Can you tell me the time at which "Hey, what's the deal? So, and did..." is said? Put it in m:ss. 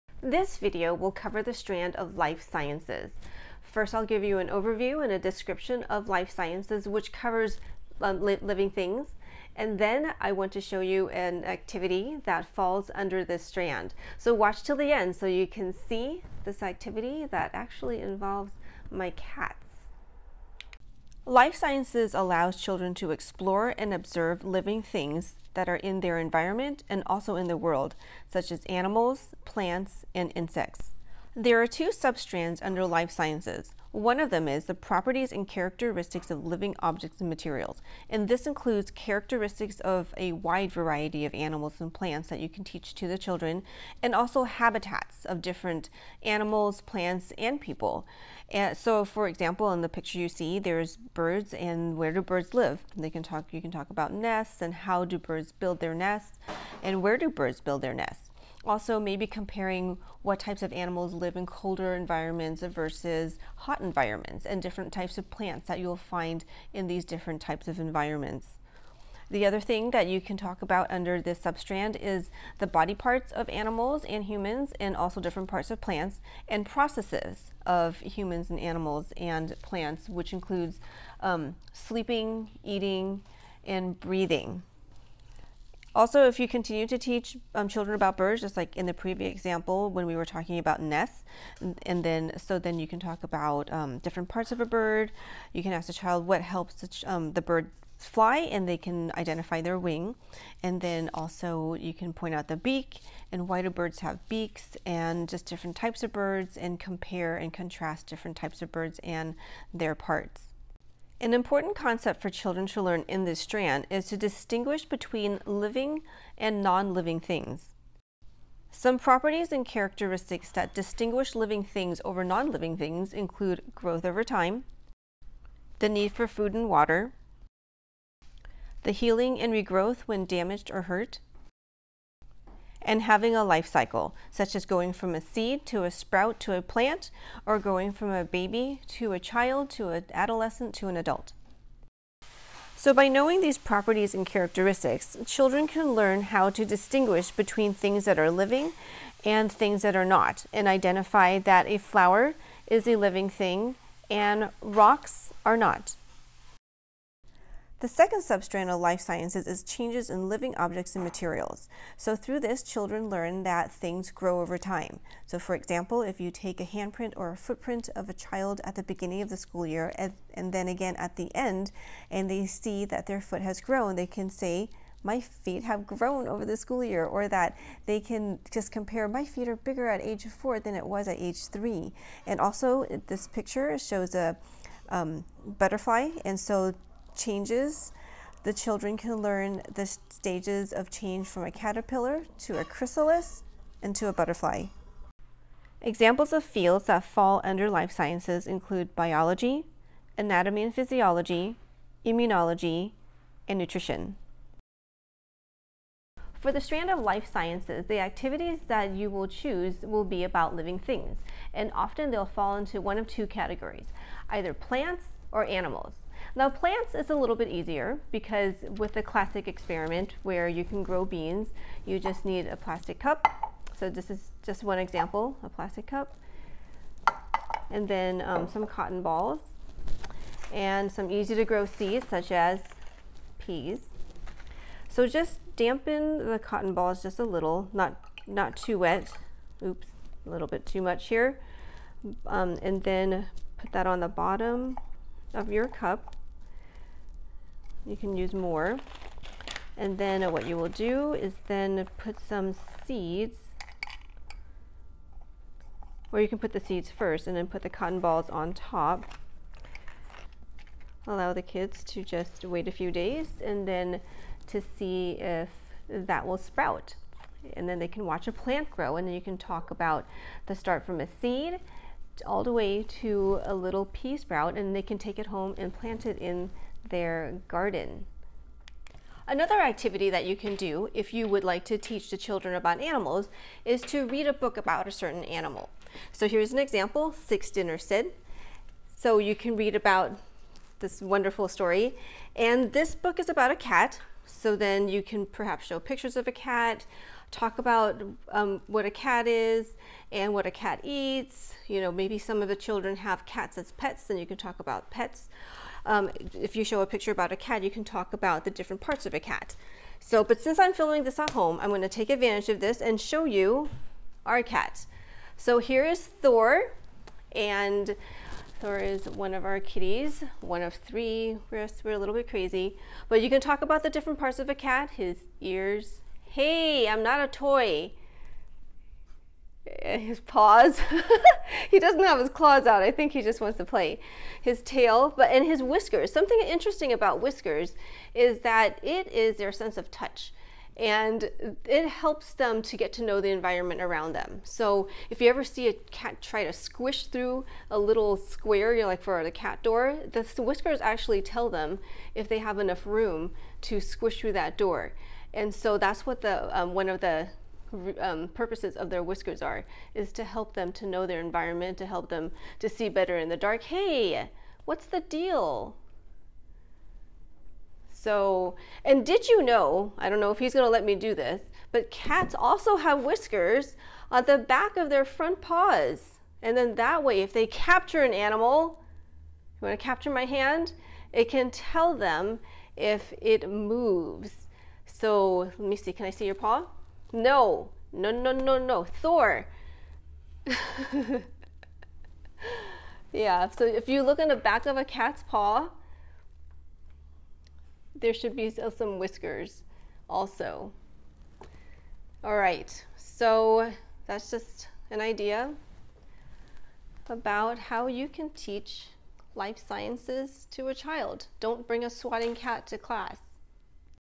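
6:03.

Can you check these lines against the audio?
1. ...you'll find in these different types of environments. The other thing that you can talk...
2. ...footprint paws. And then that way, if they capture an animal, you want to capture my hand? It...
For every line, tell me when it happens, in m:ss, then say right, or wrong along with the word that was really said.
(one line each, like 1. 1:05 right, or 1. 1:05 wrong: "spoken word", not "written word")
1. 1:05 right
2. 6:15 wrong: "front", not "footprint".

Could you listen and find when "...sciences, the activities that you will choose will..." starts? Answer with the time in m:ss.
3:27.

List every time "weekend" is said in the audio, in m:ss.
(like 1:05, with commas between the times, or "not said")
not said.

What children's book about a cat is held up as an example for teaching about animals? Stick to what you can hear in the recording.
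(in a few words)
Six Dinner Sid.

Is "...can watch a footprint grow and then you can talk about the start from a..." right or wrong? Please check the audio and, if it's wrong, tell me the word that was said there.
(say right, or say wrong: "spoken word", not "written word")
wrong: "plant", not "footprint".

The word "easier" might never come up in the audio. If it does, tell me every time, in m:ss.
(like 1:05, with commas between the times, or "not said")
3:37.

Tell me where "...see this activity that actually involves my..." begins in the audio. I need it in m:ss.
0:15.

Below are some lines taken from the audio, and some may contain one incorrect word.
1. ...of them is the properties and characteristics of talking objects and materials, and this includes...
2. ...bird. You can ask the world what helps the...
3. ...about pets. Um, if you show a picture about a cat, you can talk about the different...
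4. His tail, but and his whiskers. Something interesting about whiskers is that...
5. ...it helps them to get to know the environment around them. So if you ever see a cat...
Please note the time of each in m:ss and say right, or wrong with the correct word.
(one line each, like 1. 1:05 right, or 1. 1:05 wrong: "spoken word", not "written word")
1. 0:34 wrong: "living", not "talking"
2. 1:34 wrong: "child", not "world"
3. 5:04 right
4. 5:34 right
5. 5:41 right.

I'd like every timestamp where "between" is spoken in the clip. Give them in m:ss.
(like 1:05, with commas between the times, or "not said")
1:54, 2:27.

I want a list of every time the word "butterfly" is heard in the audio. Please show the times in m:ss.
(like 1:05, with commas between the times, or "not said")
3:05, 3:14.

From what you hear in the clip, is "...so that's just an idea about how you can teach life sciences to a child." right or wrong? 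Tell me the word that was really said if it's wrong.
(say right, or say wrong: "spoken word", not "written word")
right.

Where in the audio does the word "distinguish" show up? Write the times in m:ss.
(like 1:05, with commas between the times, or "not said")
1:54, 2:00, 2:26.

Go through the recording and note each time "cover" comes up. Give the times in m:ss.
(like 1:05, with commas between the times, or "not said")
0:01, 0:07.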